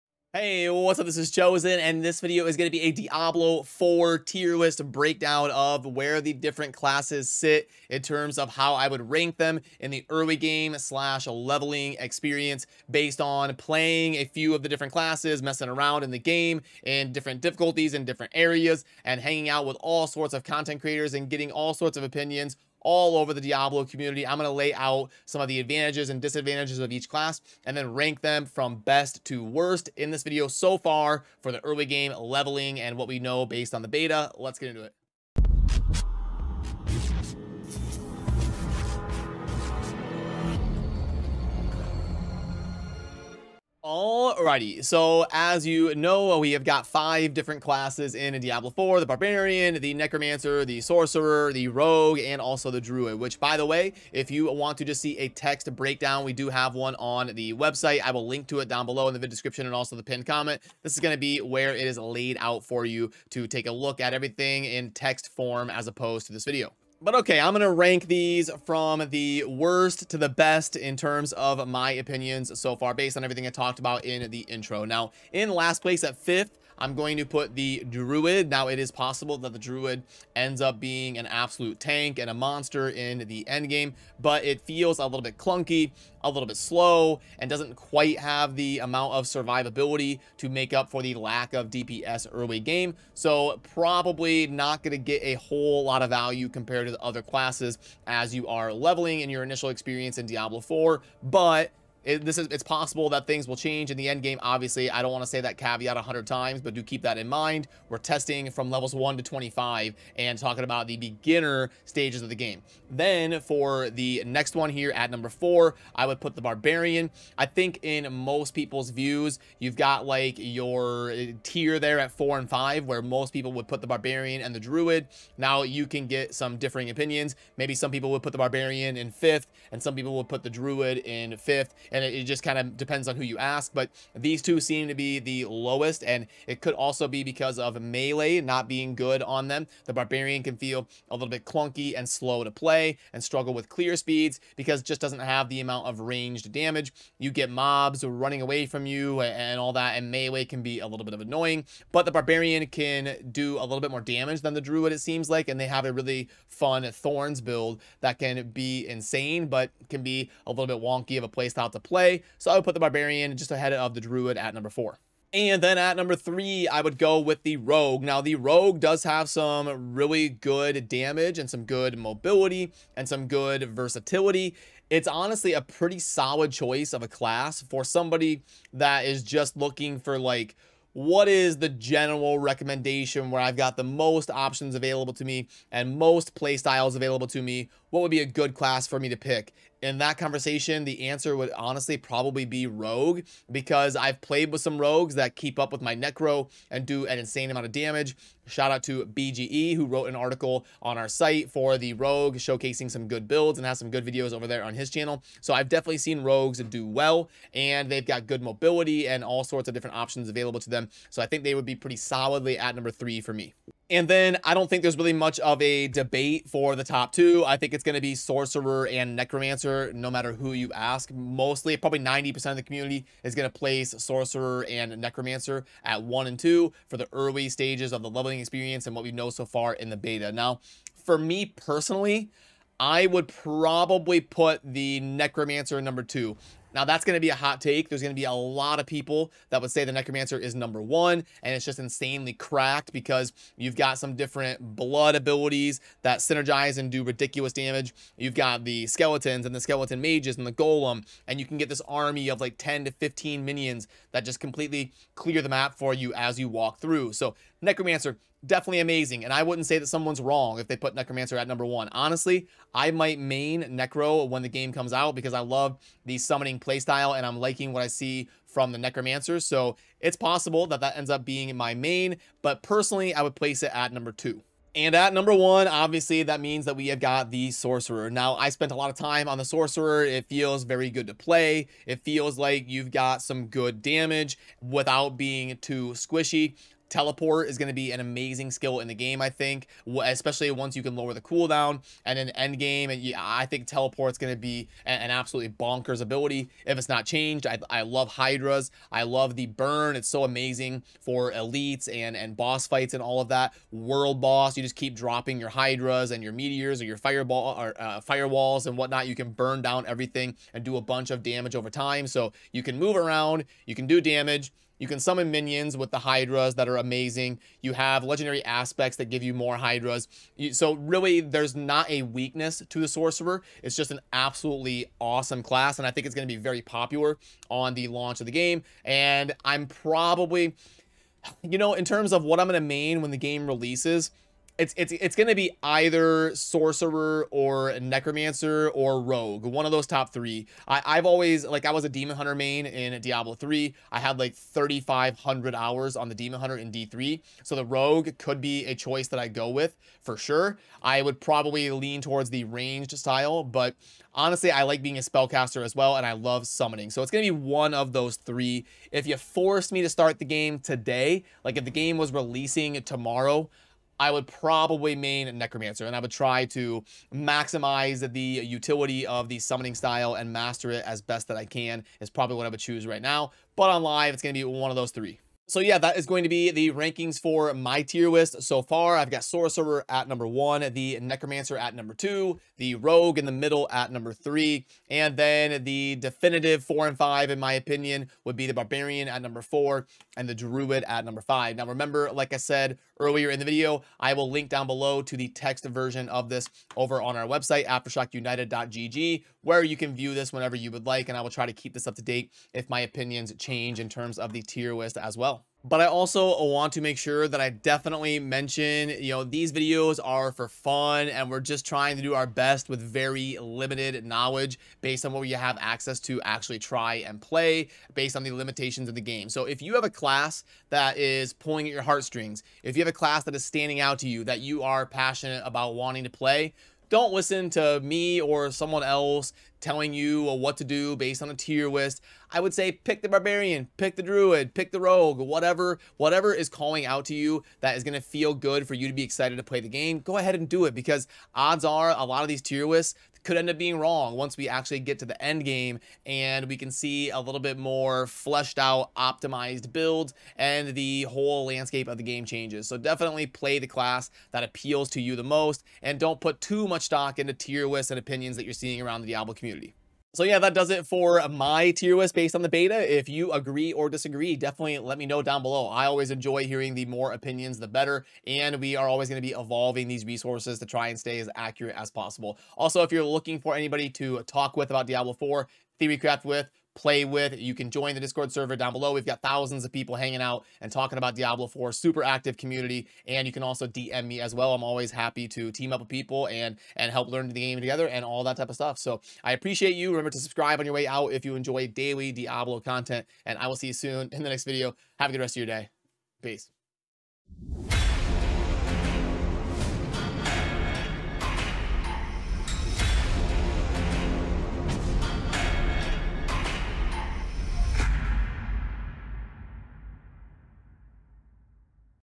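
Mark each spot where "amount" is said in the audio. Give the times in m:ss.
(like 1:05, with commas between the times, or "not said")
1:28, 2:25, 3:17.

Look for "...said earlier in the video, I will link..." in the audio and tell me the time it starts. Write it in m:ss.
6:32.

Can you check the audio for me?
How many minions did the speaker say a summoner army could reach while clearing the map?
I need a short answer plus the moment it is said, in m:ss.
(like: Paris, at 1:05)
10 to 15, at 4:12.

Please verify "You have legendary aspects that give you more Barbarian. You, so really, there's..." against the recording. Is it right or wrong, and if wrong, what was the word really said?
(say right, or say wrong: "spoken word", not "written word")
wrong: "Hydras", not "Barbarian".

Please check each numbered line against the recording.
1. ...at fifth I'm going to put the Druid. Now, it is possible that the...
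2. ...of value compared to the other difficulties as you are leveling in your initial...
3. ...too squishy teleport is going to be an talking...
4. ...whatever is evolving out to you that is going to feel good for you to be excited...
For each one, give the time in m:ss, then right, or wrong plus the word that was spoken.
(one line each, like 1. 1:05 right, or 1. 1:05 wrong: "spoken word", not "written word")
1. 1:16 right
2. 1:36 wrong: "classes", not "difficulties"
3. 4:45 wrong: "amazing", not "talking"
4. 7:15 wrong: "calling", not "evolving".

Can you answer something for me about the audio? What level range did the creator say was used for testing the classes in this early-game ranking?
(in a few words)
1 to 25.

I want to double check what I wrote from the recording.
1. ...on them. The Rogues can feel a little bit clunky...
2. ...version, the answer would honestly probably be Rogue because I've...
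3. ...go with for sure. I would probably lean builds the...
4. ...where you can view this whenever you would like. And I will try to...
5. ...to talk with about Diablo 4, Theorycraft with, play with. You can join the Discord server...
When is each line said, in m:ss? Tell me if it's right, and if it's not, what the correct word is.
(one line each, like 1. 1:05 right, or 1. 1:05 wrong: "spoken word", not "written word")
1. 2:19 wrong: "Barbarian", not "Rogues"
2. 3:10 wrong: "conversation", not "version"
3. 5:49 wrong: "towards", not "builds"
4. 6:39 right
5. 7:53 right.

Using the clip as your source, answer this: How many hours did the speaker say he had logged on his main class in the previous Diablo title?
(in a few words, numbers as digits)
3500.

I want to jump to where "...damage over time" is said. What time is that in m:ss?
5:11.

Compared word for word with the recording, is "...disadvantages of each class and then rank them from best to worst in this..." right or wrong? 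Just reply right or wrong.
right.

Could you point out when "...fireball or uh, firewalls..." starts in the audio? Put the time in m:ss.
5:06.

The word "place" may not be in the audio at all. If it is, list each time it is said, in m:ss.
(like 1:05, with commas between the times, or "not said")
1:15, 3:43, 4:33.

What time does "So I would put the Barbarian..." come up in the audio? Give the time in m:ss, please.
2:42.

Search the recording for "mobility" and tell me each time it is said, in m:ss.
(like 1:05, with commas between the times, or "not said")
2:51, 3:28.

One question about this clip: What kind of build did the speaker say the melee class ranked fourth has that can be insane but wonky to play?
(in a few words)
Thorns build.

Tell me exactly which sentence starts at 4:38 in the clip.
Now, I spent a lot of time on the Sorcerer.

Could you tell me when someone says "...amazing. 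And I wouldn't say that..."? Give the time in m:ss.
4:18.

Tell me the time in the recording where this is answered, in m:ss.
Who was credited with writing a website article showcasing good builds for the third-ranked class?
3:19.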